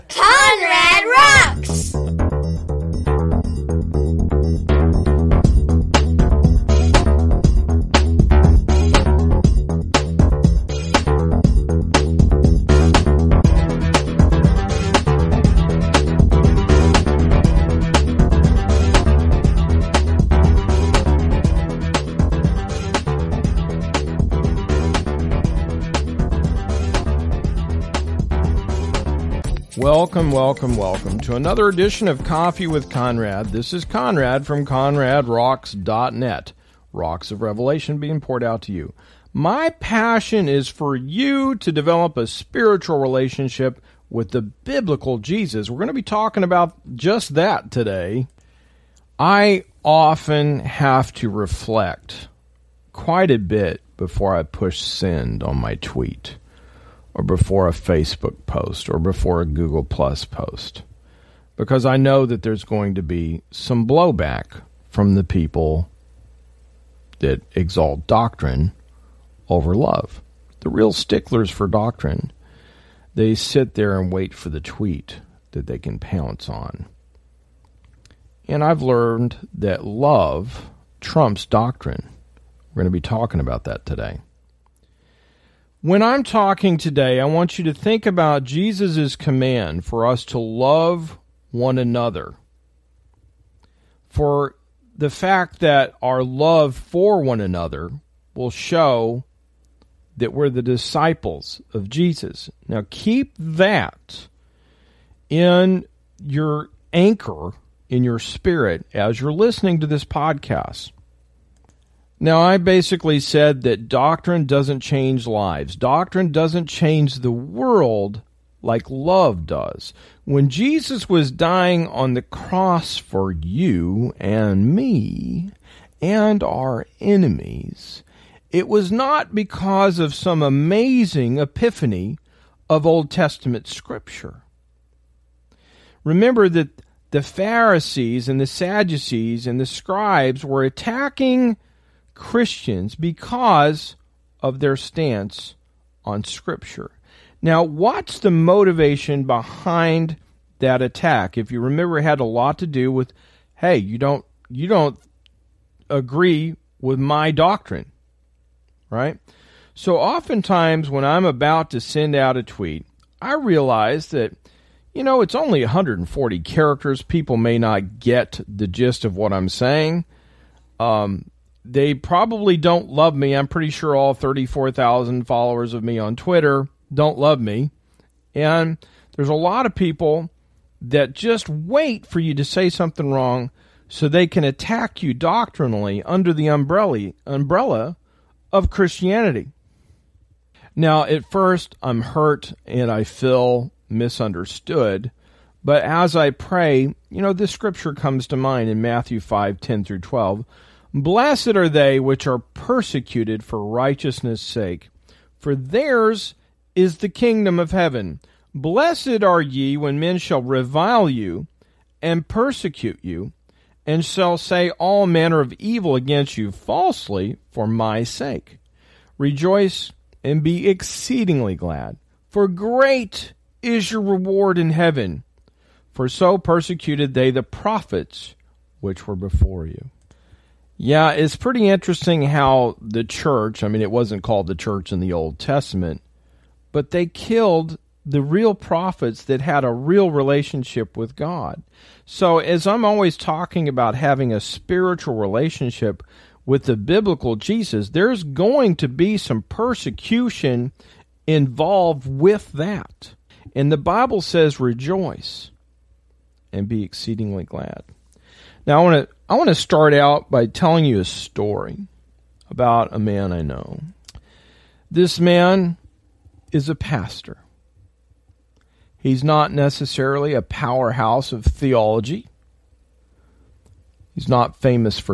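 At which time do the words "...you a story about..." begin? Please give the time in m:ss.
4:20.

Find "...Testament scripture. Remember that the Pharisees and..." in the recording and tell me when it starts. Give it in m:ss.
2:13.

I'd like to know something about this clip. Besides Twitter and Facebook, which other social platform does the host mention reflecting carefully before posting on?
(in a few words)
Google Plus.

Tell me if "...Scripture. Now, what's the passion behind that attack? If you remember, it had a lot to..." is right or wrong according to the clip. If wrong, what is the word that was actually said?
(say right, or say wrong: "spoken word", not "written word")
wrong: "motivation", not "passion".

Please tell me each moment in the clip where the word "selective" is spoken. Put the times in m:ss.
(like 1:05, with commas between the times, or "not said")
not said.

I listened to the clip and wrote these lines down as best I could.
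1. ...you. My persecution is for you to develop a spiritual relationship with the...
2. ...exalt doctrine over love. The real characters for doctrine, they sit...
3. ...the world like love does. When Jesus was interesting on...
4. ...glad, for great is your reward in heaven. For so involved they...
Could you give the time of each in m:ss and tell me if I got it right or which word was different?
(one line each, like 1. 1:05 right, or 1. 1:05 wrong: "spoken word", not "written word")
1. 0:38 wrong: "passion", not "persecution"
2. 1:07 wrong: "sticklers", not "characters"
3. 1:57 wrong: "dying", not "interesting"
4. 3:41 wrong: "persecuted", not "involved".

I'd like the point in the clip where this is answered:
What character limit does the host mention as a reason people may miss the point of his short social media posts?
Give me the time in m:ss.
2:45.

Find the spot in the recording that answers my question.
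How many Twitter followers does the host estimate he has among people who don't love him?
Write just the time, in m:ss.
2:54.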